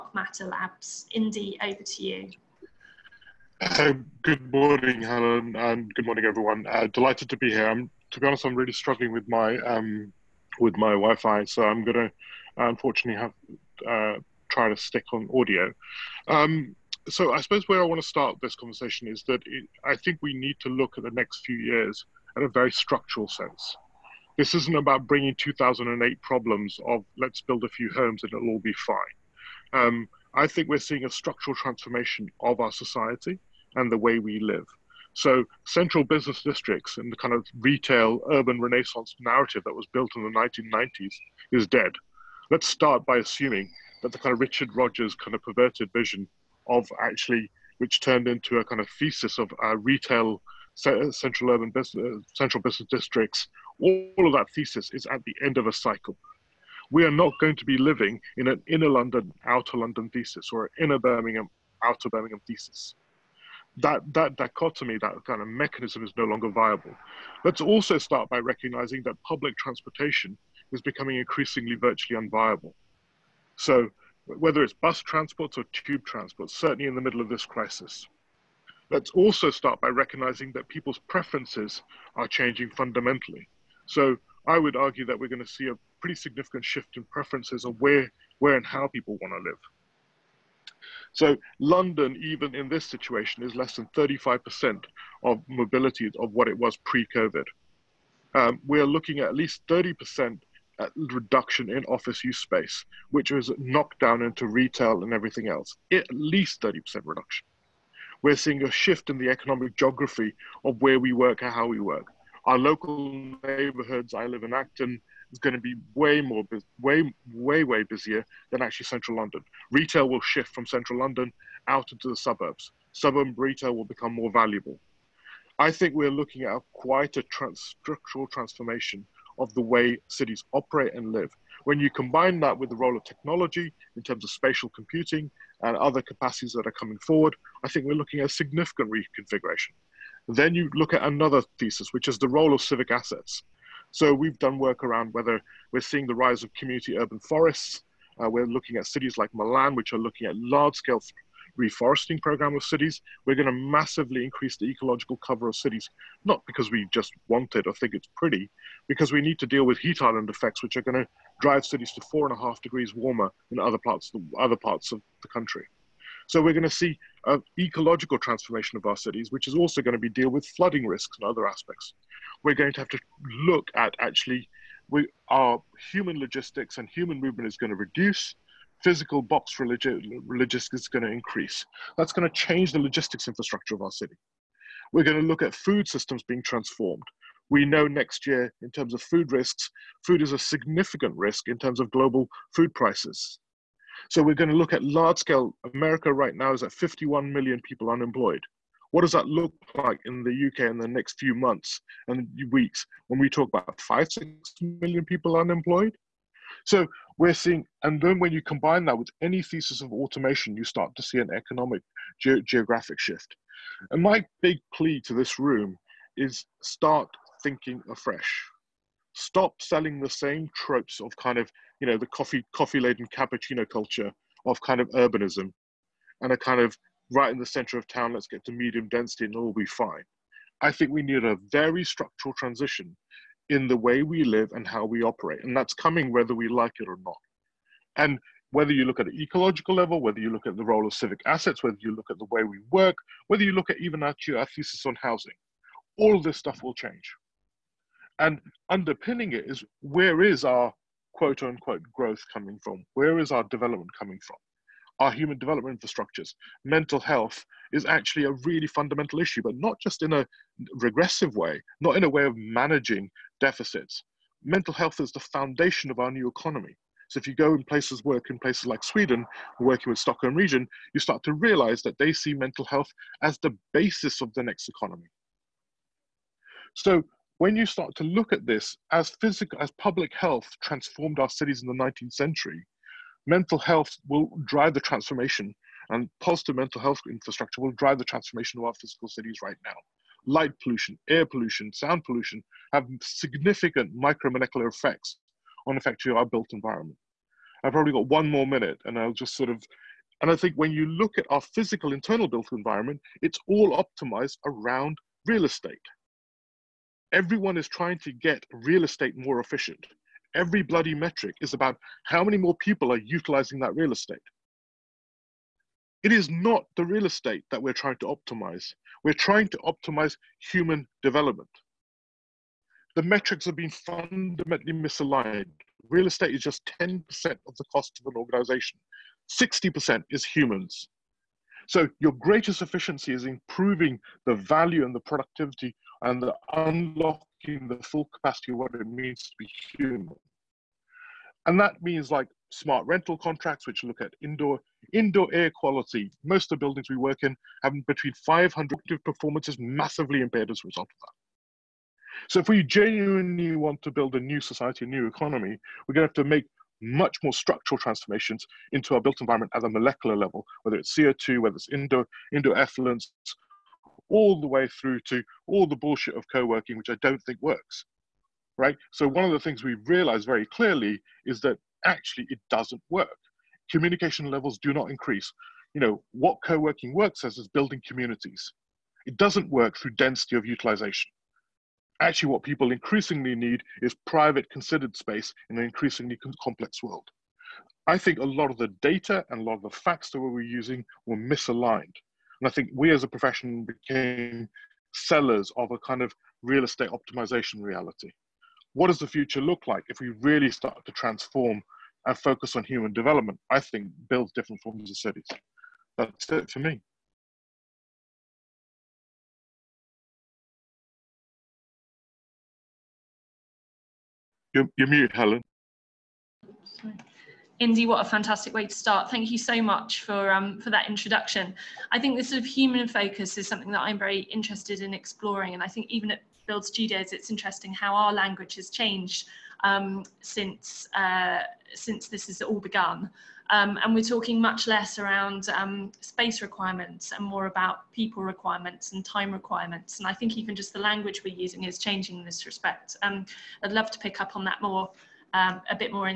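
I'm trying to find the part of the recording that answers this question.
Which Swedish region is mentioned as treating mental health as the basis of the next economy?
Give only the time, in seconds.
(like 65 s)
269 s.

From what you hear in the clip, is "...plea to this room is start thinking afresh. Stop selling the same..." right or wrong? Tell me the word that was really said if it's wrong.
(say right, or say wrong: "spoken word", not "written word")
right.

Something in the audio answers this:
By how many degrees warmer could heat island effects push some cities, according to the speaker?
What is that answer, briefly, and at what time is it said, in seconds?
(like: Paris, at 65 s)
4.5 degrees, at 162 s.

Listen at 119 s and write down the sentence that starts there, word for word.
Retail will shift from central London out into the suburbs.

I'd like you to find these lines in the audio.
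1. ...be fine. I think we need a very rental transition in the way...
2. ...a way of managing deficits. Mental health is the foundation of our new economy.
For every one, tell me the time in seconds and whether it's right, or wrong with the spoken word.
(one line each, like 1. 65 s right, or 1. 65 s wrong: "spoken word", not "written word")
1. 229 s wrong: "structural", not "rental"
2. 262 s right.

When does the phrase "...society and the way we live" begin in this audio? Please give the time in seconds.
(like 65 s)
32 s.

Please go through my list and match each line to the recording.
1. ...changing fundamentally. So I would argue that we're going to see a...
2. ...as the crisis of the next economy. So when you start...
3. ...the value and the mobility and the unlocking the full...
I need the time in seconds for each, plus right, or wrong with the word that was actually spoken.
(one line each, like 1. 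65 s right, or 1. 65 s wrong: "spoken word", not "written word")
1. 82 s right
2. 273 s wrong: "basis", not "crisis"
3. 334 s wrong: "productivity", not "mobility".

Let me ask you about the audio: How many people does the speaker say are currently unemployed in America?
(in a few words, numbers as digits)
51 million.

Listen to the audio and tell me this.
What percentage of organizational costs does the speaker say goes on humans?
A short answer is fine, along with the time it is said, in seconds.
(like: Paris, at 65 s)
60%, at 329 s.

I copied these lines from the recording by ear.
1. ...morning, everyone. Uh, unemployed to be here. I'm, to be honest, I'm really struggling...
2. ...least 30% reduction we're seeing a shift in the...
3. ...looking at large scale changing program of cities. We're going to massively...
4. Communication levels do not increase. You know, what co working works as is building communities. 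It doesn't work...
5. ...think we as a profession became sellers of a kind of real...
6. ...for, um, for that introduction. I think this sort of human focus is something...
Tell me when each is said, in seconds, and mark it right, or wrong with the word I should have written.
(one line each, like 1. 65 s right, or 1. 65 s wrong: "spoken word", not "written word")
1. 6 s wrong: "delighted", not "unemployed"
2. 106 s right
3. 149 s wrong: "reforesting", not "changing"
4. 373 s right
5. 392 s right
6. 420 s right.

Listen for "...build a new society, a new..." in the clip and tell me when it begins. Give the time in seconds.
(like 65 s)
353 s.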